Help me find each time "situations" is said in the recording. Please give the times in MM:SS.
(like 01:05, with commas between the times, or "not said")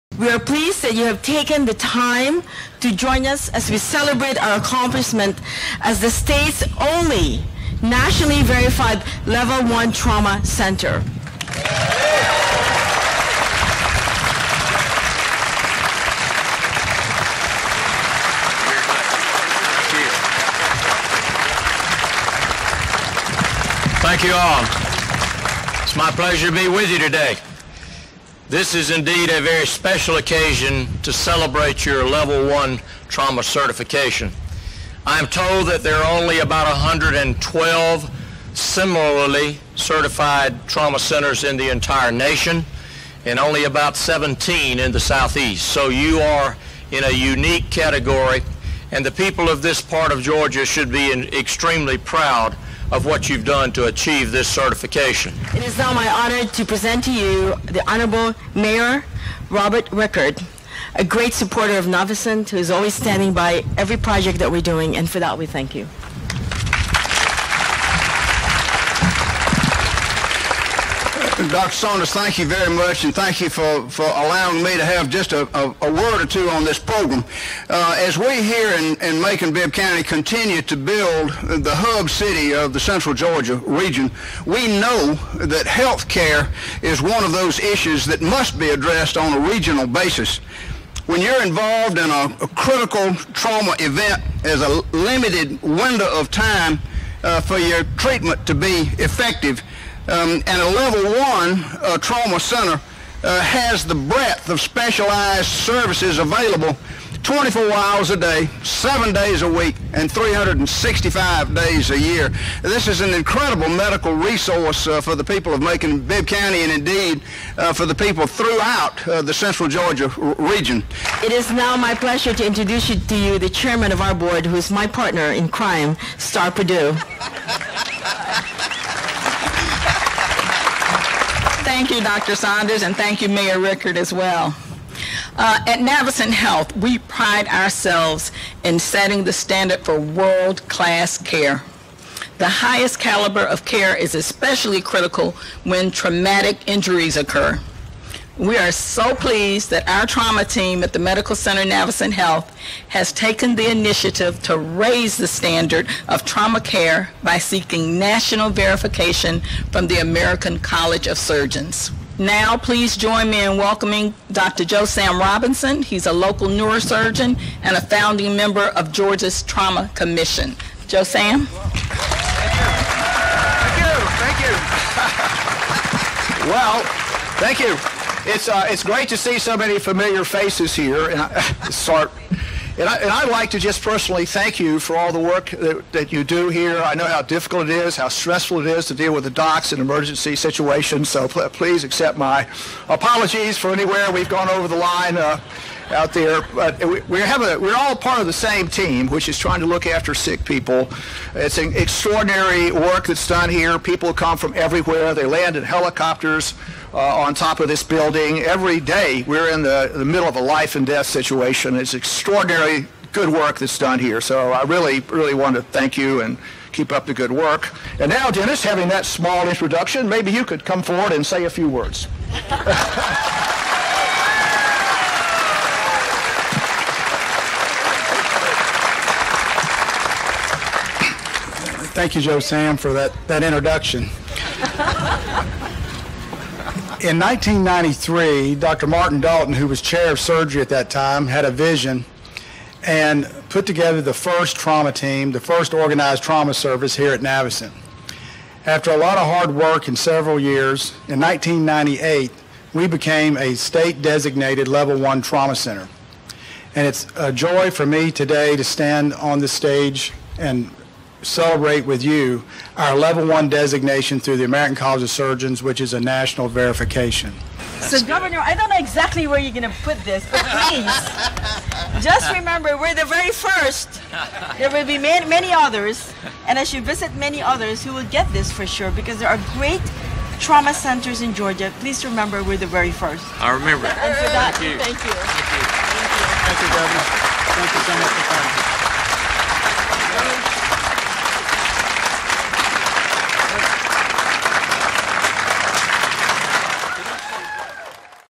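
03:10, 03:31.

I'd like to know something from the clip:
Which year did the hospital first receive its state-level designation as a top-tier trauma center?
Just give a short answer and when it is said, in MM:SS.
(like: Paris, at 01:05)
1998, at 04:11.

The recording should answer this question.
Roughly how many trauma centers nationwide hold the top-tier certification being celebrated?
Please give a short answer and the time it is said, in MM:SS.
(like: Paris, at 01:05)
112, at 00:36.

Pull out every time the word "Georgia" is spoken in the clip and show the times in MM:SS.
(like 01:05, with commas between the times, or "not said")
00:50, 01:23, 01:59, 02:48, 04:41.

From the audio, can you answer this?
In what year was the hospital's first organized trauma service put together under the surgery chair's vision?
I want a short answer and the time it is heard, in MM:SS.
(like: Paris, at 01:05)
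1993, at 03:57.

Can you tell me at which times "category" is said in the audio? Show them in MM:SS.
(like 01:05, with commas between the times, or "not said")
00:47.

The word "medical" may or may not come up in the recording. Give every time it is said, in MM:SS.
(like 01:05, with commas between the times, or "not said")
01:53, 02:30.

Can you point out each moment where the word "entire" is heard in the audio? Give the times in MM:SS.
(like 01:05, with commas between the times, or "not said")
00:41.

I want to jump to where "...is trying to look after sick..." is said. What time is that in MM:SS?
03:19.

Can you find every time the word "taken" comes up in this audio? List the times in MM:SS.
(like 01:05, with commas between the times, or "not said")
00:01, 02:33.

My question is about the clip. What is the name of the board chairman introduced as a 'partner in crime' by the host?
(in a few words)
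Starr Purdue.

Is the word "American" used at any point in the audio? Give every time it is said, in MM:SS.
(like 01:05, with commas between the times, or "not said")
02:39, 04:24.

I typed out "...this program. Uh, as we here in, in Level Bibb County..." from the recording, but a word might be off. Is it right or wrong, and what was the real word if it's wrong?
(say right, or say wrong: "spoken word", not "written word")
wrong: "Macon", not "Level".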